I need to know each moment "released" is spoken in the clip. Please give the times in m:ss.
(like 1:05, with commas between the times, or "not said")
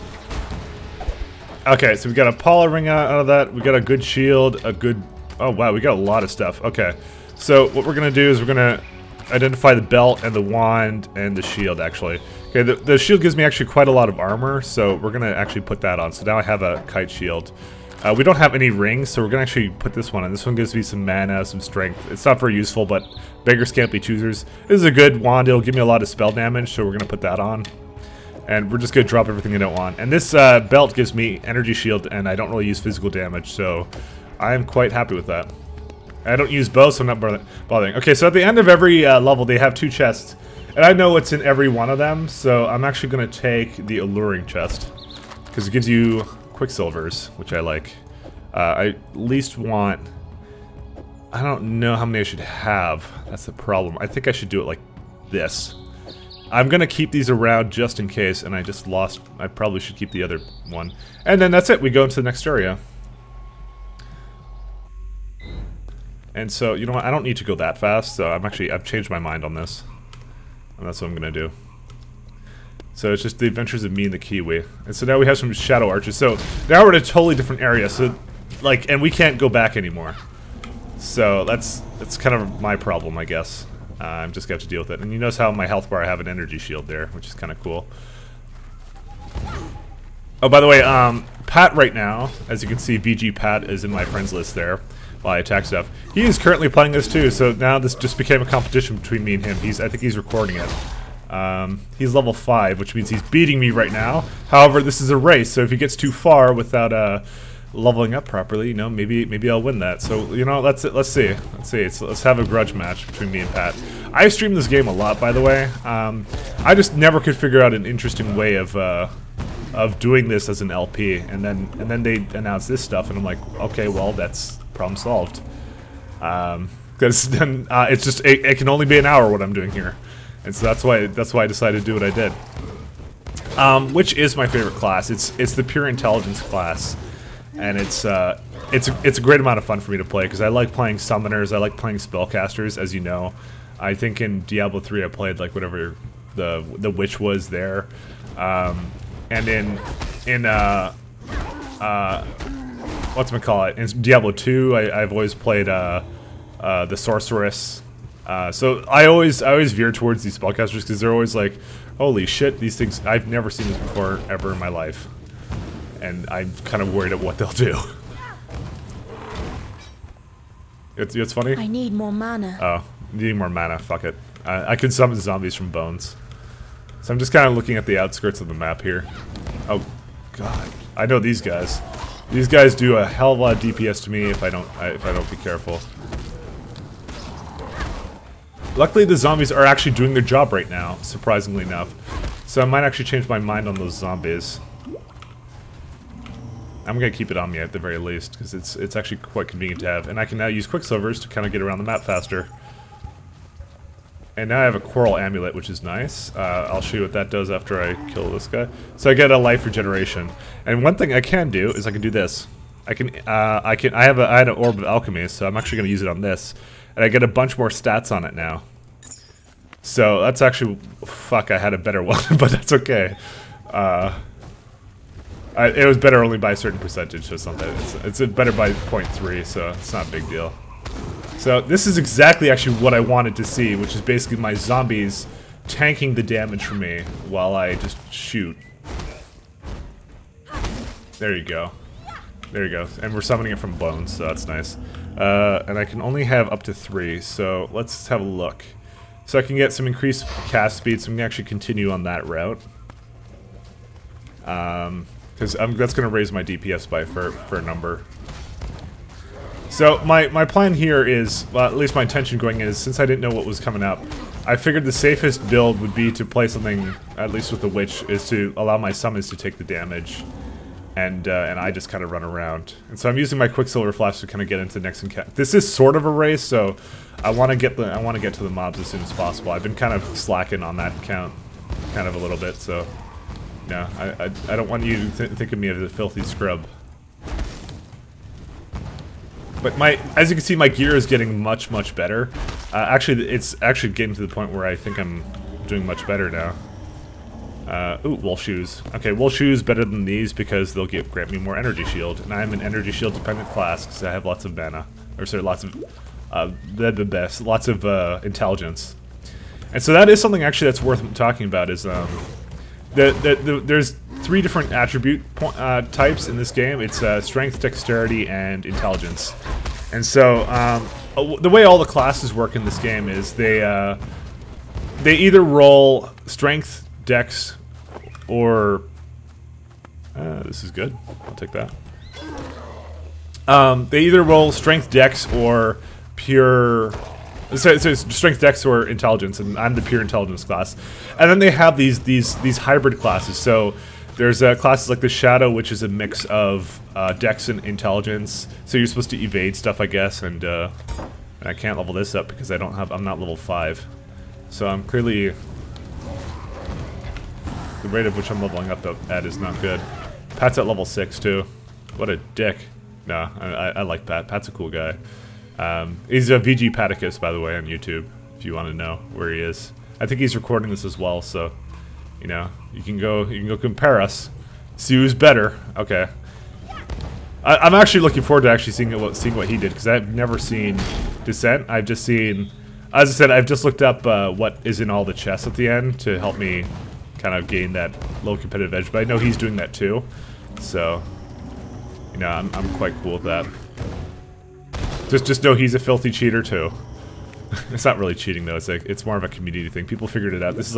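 not said.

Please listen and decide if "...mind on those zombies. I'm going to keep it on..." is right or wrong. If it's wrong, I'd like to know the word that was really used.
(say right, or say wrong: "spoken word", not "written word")
right.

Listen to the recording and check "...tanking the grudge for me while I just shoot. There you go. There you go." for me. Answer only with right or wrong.
wrong.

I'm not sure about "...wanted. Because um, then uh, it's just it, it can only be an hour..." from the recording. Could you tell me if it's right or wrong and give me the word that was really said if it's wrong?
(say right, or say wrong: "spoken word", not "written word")
wrong: "solved", not "wanted".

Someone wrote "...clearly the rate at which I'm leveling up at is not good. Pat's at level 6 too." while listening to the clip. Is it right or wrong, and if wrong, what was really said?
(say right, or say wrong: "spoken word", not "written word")
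right.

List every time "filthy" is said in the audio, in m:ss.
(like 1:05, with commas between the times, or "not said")
4:45, 6:35.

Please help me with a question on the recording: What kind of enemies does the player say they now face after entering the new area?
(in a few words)
Shadow archers.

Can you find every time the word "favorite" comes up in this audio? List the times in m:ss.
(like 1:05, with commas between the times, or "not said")
2:14.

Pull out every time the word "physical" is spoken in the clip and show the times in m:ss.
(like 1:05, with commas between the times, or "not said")
0:32.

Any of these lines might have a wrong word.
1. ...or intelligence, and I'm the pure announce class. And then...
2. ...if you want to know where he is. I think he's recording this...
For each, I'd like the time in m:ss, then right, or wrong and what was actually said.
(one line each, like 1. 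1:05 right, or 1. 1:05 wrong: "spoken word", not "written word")
1. 5:38 wrong: "intelligence", not "announce"
2. 6:08 right.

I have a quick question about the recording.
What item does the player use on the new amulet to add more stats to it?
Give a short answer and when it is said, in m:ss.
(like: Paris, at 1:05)
Orb of Alchemy, at 3:34.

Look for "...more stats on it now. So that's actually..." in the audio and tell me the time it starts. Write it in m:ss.
3:37.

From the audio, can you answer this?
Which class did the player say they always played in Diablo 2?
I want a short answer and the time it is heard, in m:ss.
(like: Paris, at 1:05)
Sorceress, at 2:36.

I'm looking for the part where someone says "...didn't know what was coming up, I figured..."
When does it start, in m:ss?
4:23.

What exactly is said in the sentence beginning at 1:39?
He's, I think he's recording it.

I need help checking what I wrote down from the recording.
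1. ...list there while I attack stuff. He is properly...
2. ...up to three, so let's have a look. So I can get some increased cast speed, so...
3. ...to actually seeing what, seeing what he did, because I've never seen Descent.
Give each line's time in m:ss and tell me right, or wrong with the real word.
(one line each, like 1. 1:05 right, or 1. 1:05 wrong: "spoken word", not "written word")
1. 1:34 wrong: "currently", not "properly"
2. 4:06 right
3. 6:18 right.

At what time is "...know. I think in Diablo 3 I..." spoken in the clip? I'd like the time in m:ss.
2:23.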